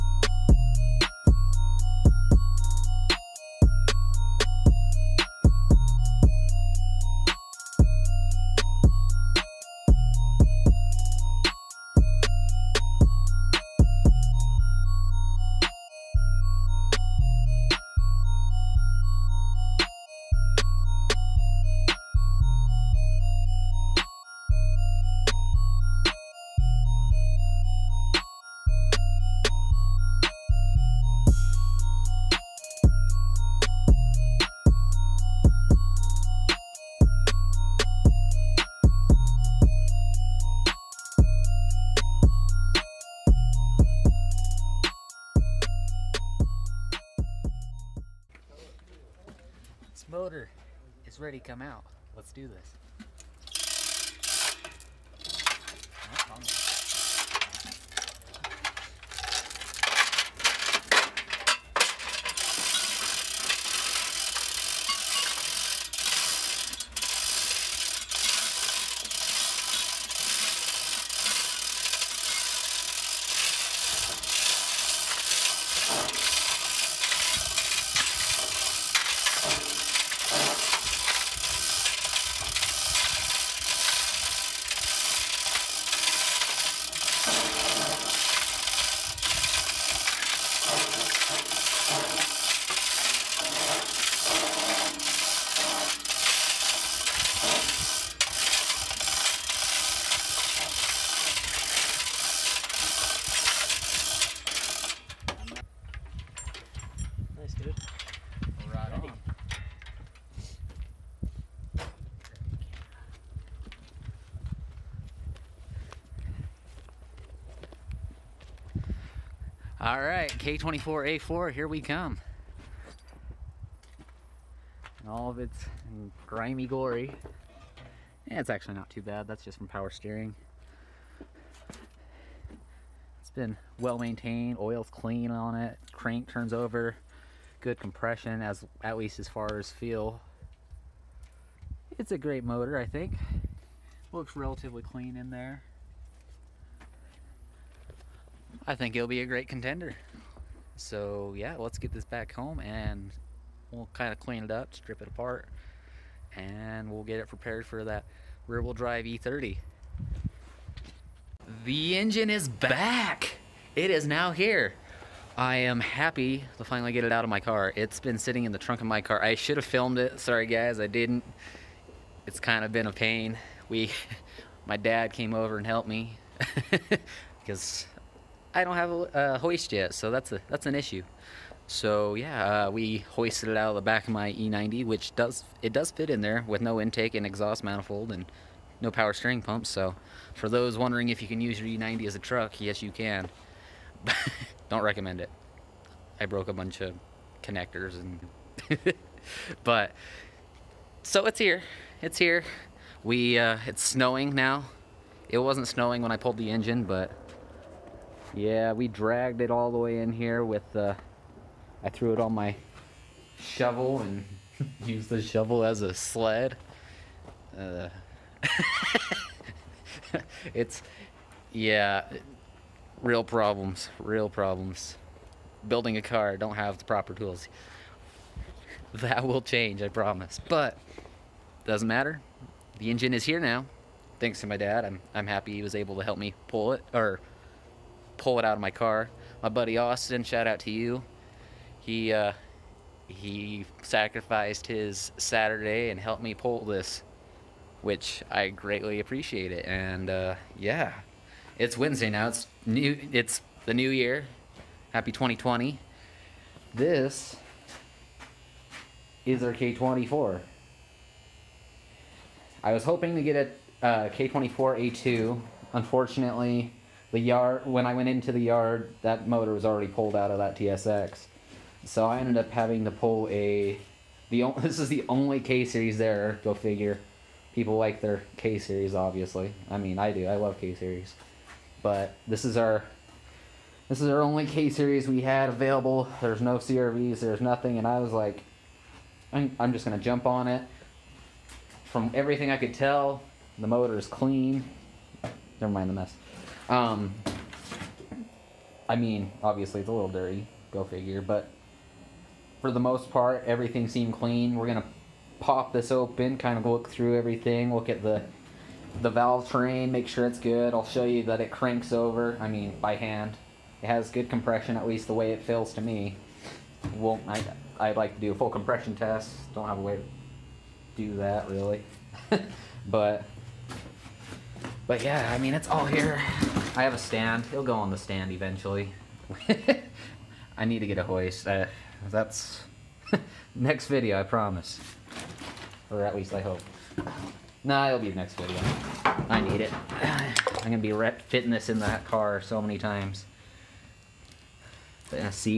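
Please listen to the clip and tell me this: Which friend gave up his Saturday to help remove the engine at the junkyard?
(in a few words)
Austin.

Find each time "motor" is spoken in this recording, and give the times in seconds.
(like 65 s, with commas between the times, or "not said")
142 s, 269 s, 293 s.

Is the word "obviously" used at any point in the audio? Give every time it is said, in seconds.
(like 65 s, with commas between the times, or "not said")
278 s, 299 s.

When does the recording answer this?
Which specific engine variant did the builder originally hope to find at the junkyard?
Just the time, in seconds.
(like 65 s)
264 s.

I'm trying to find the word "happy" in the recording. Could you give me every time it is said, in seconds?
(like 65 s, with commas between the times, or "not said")
165 s, 235 s, 254 s.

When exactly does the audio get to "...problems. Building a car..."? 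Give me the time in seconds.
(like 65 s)
224 s.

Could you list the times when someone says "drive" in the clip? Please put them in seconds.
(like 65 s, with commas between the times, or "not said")
158 s.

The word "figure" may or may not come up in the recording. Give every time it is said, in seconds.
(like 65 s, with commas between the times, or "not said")
276 s, 300 s.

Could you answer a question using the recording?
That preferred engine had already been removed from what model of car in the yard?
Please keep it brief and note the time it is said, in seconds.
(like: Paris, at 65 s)
TSX, at 270 s.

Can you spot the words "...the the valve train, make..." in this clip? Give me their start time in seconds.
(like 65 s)
308 s.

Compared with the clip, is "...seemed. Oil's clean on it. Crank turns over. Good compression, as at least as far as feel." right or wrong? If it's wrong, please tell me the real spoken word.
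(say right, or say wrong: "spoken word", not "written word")
wrong: "maintained", not "seemed".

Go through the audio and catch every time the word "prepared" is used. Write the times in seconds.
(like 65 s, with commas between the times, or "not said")
157 s.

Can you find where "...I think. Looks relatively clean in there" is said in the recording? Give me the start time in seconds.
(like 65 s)
142 s.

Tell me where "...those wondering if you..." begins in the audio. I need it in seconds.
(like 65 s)
190 s.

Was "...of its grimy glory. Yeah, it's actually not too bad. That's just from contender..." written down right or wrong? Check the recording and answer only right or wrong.
wrong.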